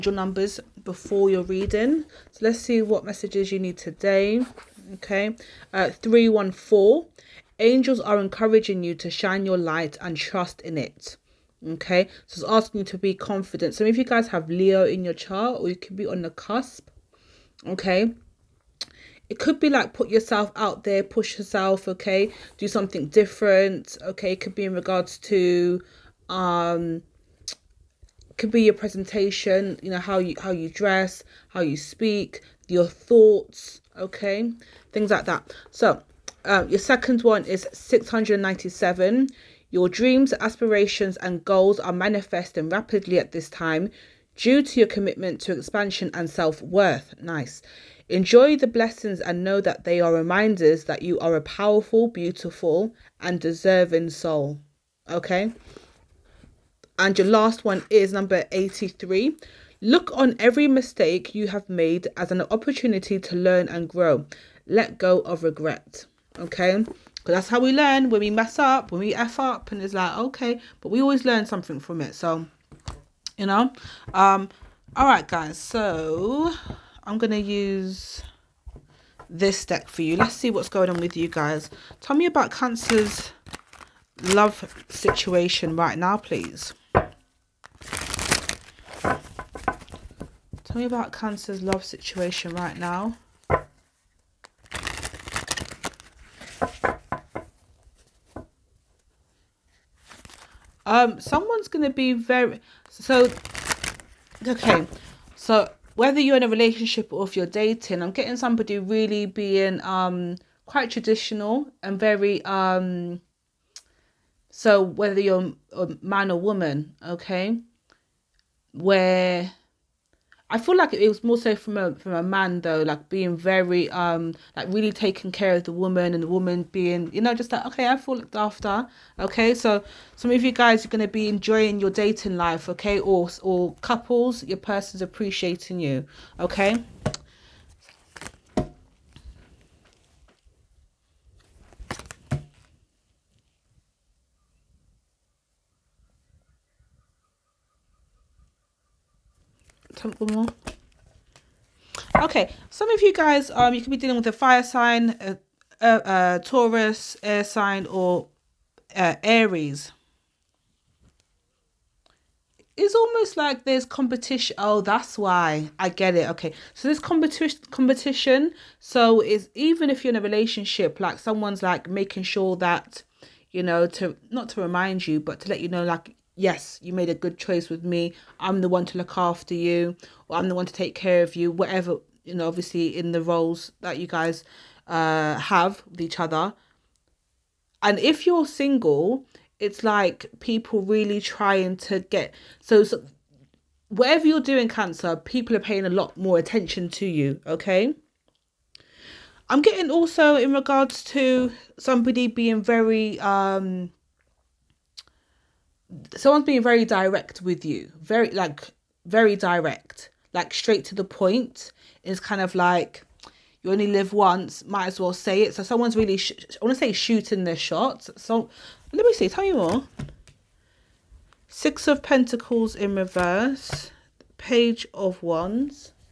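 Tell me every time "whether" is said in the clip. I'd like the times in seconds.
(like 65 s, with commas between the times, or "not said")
105 s, 114 s.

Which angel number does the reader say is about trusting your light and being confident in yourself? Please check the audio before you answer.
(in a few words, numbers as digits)
314.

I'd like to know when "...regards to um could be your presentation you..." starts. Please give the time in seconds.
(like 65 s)
24 s.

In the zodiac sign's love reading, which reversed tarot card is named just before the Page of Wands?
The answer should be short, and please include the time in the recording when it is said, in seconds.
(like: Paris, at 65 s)
Six of Pentacles, at 221 s.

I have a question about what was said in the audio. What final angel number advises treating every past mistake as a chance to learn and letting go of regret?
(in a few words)
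83.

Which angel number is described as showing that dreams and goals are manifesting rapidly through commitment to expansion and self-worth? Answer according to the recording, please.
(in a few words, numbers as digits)
697.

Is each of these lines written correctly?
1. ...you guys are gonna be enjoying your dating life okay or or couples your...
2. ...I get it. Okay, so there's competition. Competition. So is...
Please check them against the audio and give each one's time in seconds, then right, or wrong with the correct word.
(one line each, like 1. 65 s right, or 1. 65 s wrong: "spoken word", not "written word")
1. 130 s right
2. 165 s right.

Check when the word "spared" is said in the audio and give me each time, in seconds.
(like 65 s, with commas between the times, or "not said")
not said.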